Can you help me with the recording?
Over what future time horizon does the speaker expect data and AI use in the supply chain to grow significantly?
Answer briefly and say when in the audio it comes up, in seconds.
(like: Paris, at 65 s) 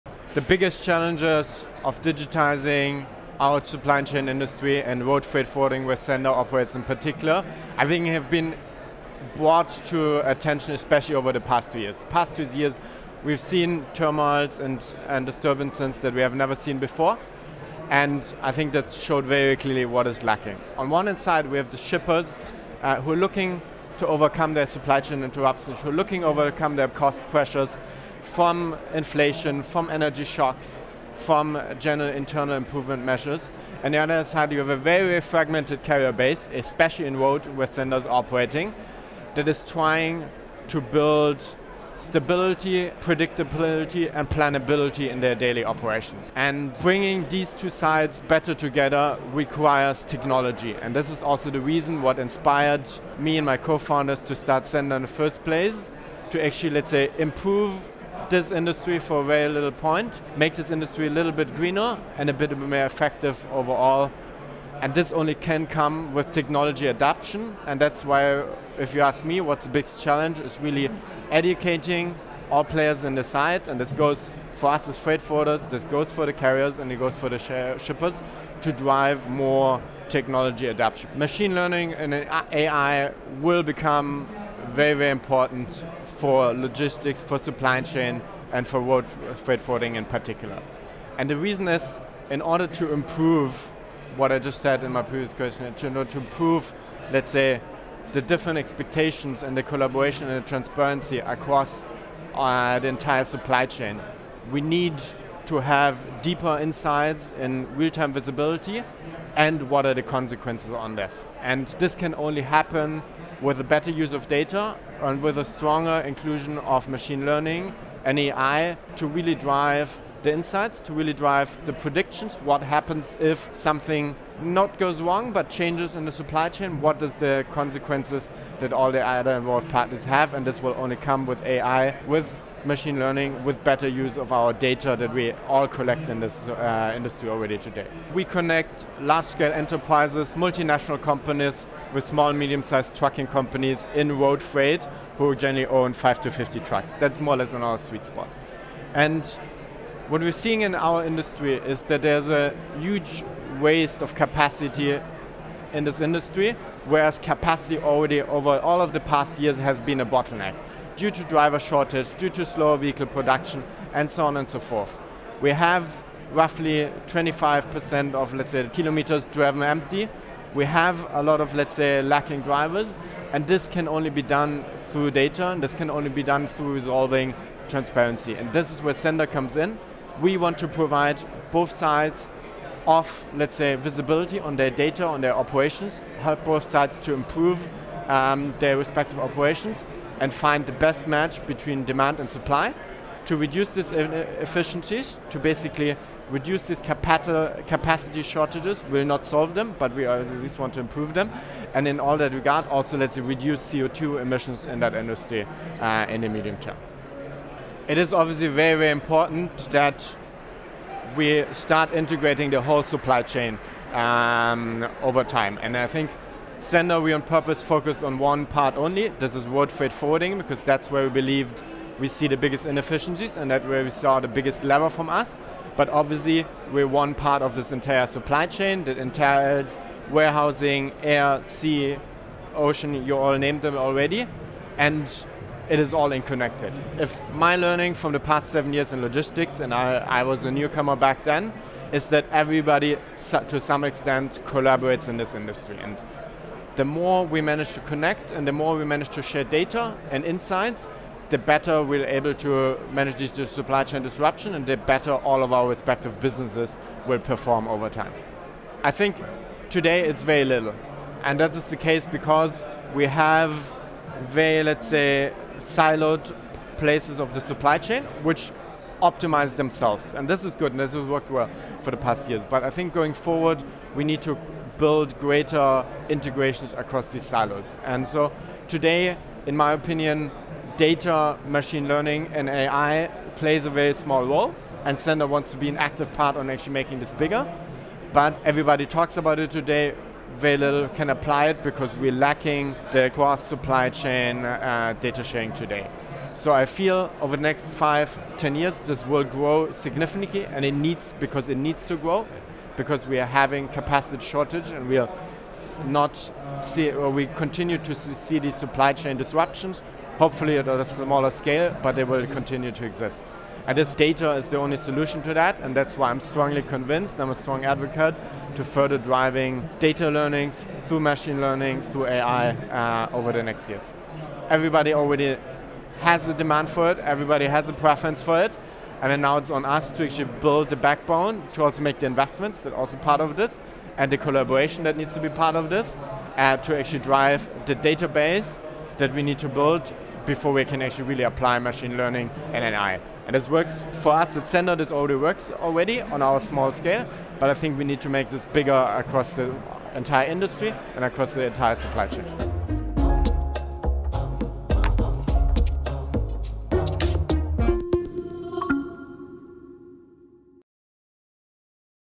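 Five, ten years, at 297 s.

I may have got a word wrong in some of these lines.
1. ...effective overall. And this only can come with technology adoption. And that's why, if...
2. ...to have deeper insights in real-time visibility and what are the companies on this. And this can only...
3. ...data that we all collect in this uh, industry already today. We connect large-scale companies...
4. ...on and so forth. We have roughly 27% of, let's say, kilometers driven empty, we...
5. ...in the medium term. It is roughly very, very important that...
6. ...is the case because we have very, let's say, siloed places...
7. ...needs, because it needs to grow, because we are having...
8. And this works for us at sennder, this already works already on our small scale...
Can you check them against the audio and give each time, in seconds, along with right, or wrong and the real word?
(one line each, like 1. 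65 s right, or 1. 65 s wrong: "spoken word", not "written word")
1. 62 s right
2. 105 s wrong: "consequences", not "companies"
3. 134 s wrong: "enterprises", not "companies"
4. 164 s wrong: "25", not "27"
5. 206 s wrong: "obviously", not "roughly"
6. 261 s right
7. 300 s right
8. 343 s right.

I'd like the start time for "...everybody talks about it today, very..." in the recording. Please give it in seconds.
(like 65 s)
288 s.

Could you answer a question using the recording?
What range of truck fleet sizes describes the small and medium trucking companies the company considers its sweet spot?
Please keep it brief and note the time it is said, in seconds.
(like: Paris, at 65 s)
5 to 50 trucks, at 145 s.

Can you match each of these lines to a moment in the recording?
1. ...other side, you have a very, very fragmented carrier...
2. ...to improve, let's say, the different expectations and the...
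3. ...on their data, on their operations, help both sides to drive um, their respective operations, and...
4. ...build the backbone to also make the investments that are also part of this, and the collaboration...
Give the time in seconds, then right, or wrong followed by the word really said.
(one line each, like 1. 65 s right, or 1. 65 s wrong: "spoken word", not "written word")
1. 33 s right
2. 96 s right
3. 184 s wrong: "improve", not "drive"
4. 330 s right.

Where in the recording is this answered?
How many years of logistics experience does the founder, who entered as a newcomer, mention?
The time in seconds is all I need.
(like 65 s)
238 s.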